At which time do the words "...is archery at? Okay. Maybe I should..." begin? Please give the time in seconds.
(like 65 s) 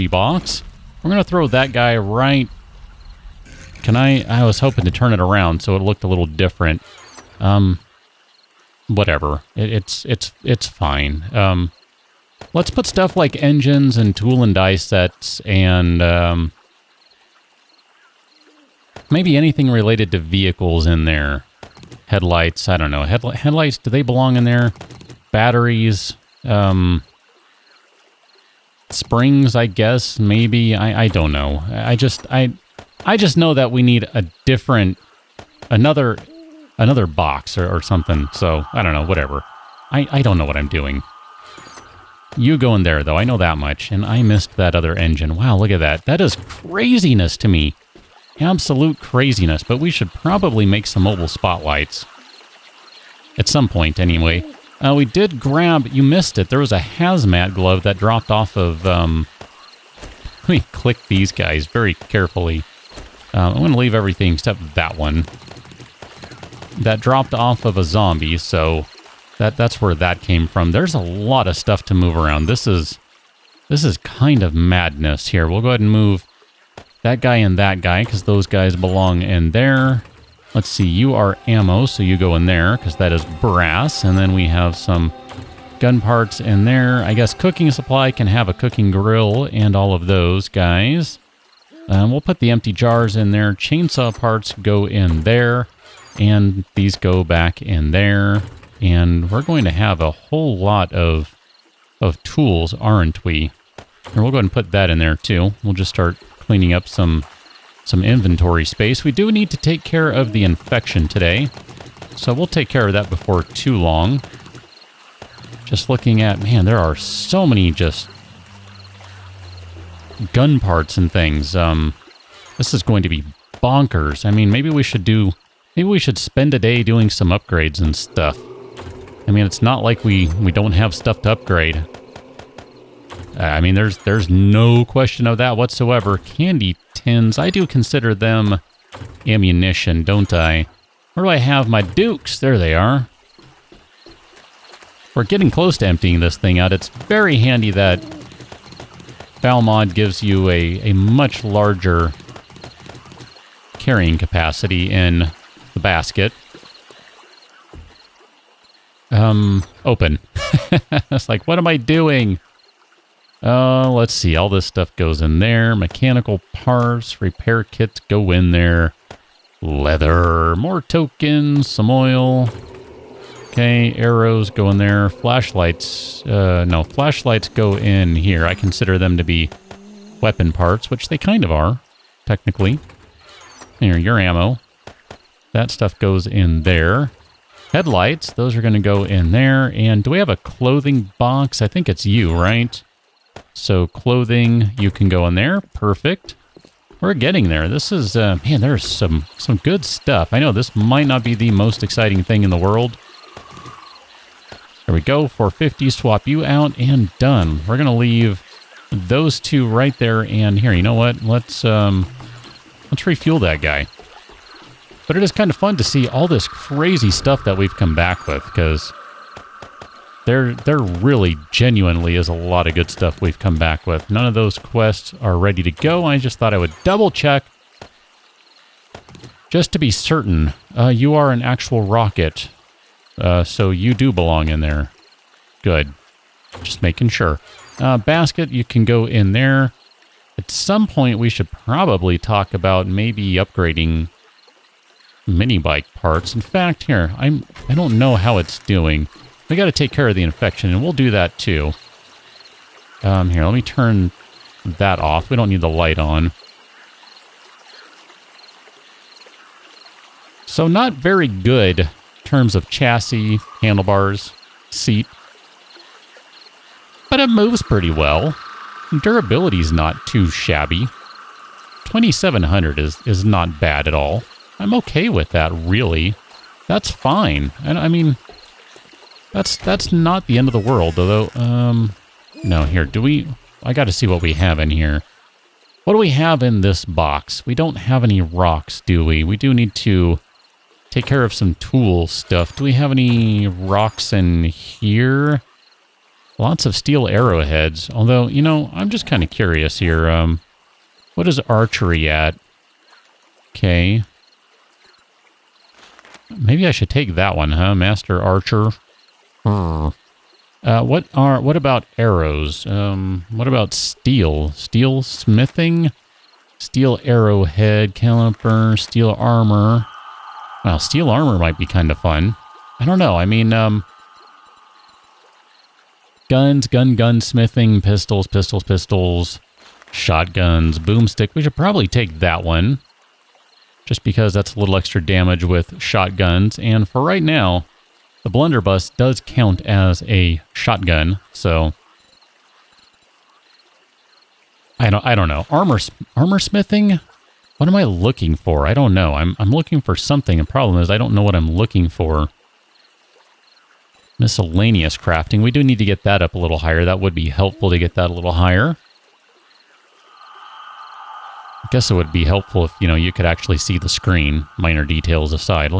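301 s.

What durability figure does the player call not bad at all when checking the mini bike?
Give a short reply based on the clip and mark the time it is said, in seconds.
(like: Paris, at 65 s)
2700, at 271 s.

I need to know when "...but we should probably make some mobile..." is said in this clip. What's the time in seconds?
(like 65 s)
49 s.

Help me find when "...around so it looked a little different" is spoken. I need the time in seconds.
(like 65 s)
5 s.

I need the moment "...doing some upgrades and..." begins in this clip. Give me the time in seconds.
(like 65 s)
126 s.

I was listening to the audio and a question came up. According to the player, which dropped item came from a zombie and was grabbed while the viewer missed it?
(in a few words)
Hazmat glove.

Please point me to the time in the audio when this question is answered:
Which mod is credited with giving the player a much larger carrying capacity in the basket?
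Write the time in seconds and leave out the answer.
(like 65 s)
149 s.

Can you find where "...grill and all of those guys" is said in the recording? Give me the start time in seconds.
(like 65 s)
88 s.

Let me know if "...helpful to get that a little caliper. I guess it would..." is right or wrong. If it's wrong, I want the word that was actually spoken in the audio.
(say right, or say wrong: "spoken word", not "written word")
wrong: "higher", not "caliper".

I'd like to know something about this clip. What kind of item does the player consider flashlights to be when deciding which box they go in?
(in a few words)
Weapon parts.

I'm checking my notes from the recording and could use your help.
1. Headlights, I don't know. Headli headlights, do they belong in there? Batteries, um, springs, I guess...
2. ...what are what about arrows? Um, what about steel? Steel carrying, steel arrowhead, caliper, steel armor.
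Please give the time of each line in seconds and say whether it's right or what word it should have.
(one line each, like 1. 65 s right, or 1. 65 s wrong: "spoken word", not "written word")
1. 22 s right
2. 310 s wrong: "smithing", not "carrying".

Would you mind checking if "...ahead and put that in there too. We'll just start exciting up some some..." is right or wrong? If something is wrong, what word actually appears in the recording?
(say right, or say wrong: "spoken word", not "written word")
wrong: "cleaning", not "exciting".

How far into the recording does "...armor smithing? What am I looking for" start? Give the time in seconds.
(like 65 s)
346 s.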